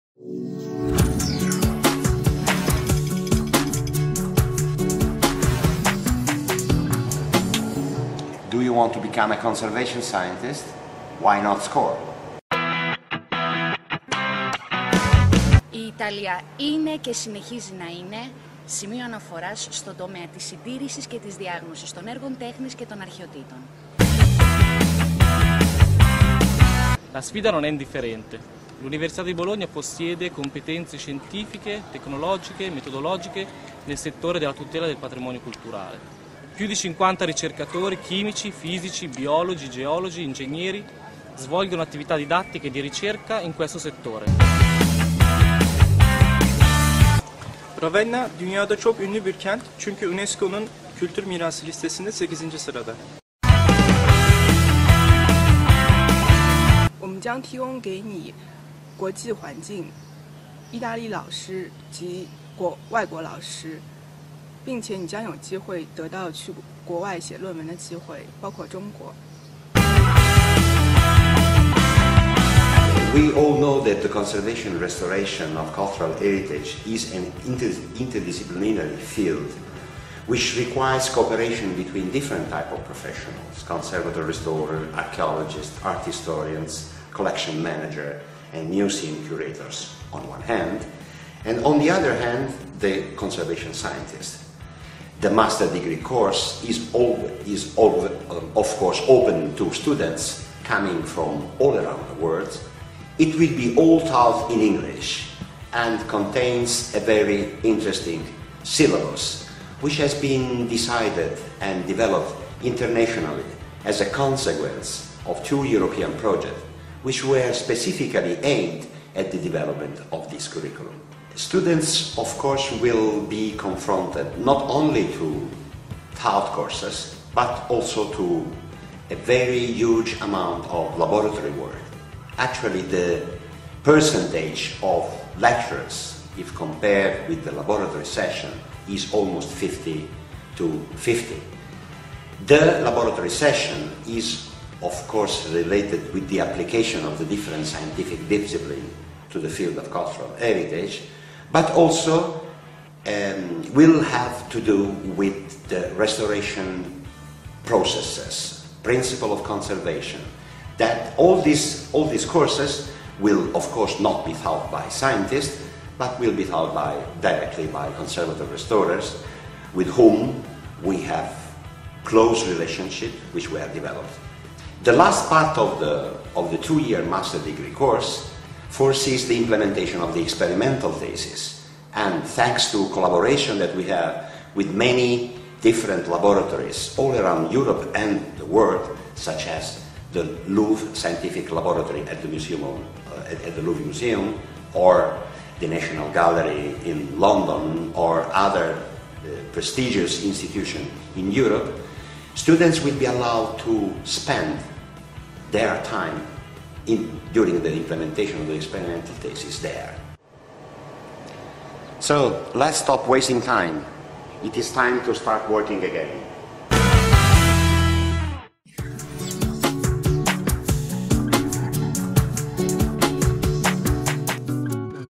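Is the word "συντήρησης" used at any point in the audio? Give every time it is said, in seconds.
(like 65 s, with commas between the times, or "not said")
20 s.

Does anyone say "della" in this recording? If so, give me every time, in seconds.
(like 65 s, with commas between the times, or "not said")
34 s.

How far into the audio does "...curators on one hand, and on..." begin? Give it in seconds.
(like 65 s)
89 s.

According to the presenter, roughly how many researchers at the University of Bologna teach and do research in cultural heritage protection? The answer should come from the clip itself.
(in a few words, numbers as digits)
More than 50.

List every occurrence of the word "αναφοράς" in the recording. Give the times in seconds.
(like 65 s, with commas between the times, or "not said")
19 s.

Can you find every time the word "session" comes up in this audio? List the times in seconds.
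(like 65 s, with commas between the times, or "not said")
138 s, 143 s.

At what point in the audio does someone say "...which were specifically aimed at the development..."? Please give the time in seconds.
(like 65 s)
117 s.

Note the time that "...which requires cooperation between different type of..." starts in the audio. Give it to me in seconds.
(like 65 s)
80 s.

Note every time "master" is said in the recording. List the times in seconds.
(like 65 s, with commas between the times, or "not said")
95 s, 177 s.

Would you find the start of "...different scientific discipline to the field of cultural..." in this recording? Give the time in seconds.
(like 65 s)
147 s.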